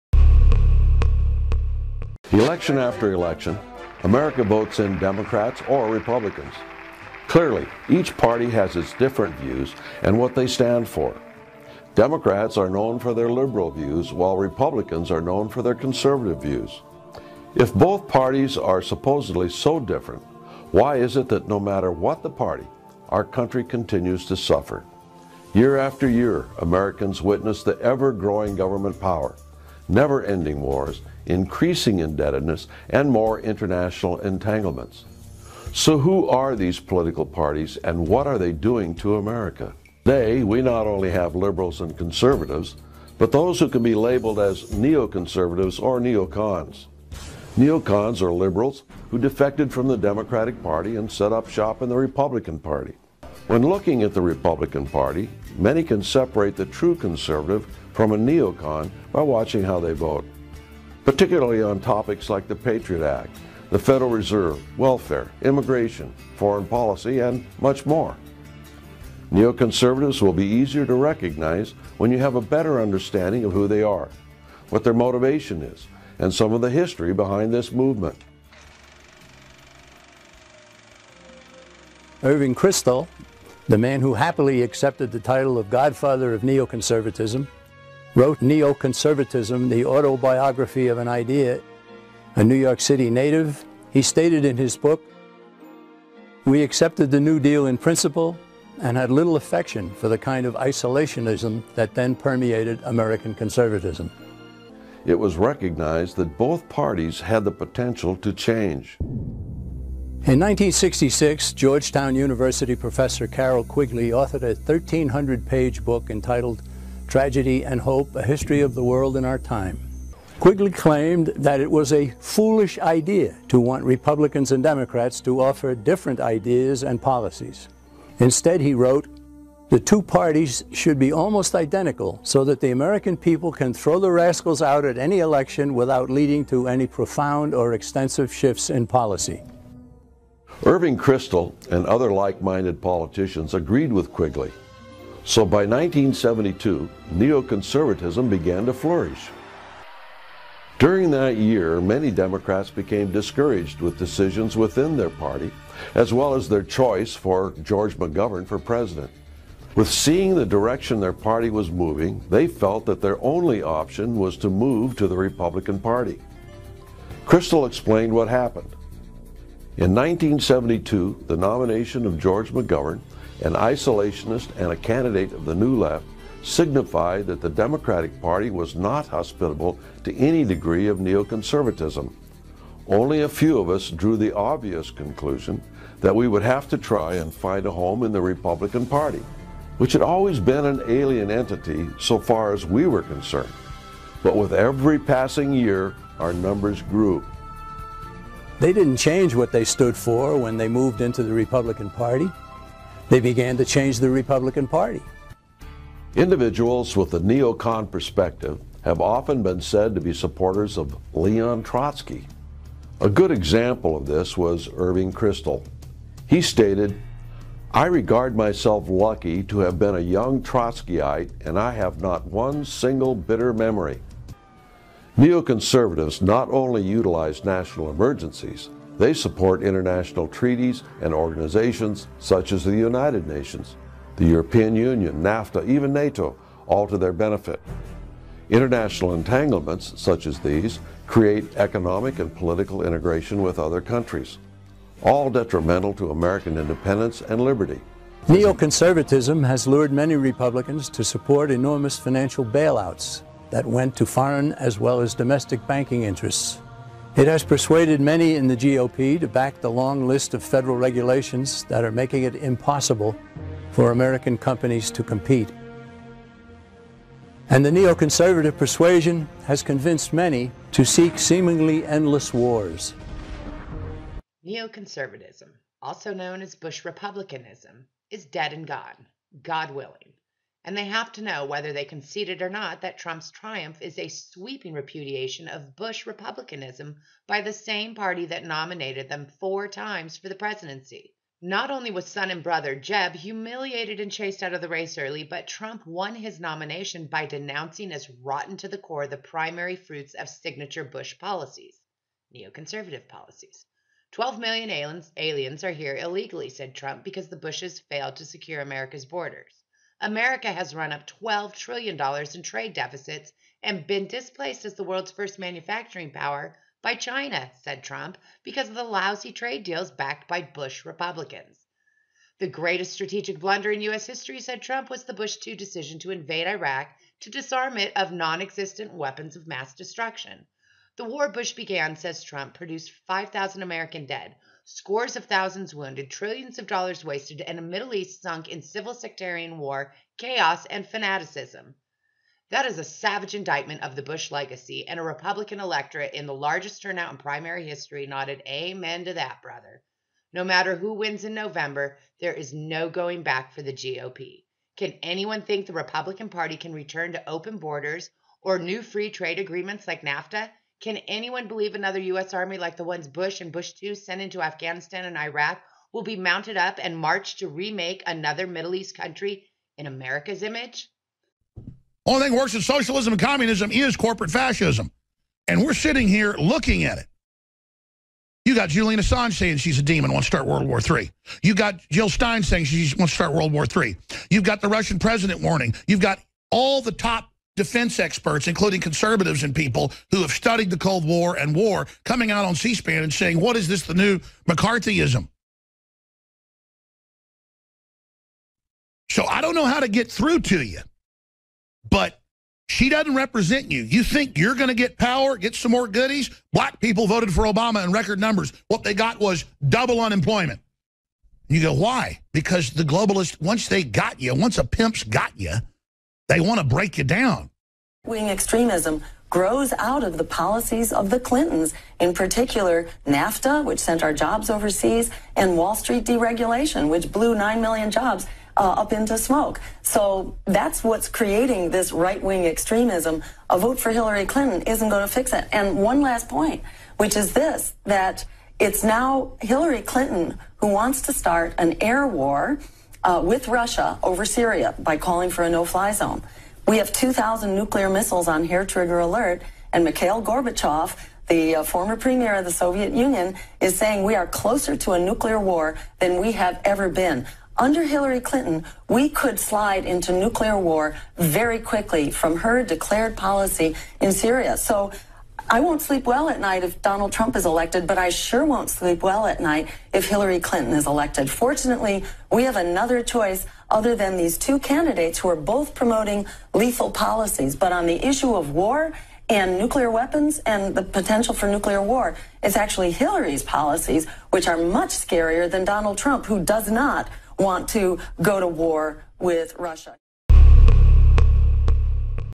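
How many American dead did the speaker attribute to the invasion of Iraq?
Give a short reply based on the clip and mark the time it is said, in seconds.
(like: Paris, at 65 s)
5,000, at 333 s.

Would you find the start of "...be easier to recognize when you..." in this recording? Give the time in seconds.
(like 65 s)
70 s.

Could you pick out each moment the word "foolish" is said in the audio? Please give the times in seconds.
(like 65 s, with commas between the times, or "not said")
122 s.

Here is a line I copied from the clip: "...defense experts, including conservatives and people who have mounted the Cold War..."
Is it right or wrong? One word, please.
wrong.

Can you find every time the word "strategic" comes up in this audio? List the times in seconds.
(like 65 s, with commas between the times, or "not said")
322 s.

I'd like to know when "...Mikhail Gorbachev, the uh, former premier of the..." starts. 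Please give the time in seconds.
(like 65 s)
449 s.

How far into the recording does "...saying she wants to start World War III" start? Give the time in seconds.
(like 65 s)
382 s.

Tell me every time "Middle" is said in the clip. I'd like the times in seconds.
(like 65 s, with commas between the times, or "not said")
337 s, 368 s.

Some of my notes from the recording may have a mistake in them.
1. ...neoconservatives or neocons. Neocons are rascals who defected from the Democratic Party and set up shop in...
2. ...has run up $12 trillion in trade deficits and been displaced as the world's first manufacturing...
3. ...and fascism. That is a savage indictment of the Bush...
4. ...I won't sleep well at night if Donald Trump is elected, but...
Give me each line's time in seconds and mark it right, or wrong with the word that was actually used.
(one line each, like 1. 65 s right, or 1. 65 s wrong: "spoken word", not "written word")
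1. 44 s wrong: "liberals", not "rascals"
2. 310 s right
3. 340 s wrong: "fanaticism", not "fascism"
4. 465 s right.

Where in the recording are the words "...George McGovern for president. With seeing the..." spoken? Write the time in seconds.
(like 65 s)
157 s.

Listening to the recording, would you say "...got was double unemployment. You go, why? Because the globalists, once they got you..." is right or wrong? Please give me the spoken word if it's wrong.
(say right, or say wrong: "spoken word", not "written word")
right.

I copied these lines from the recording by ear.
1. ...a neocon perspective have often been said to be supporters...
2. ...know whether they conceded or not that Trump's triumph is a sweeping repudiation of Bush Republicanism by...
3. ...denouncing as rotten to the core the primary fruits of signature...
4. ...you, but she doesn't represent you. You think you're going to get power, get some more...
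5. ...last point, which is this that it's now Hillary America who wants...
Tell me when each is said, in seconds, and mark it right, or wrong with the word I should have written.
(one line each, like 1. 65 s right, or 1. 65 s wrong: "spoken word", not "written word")
1. 207 s right
2. 281 s right
3. 297 s right
4. 400 s right
5. 436 s wrong: "Clinton", not "America".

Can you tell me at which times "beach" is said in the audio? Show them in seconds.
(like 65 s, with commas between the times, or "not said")
not said.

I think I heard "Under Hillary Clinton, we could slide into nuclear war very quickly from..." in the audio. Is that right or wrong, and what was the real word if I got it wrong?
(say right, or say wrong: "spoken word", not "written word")
right.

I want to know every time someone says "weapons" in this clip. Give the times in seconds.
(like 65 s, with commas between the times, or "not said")
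328 s, 479 s.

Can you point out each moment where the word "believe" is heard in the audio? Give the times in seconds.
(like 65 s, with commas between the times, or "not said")
361 s.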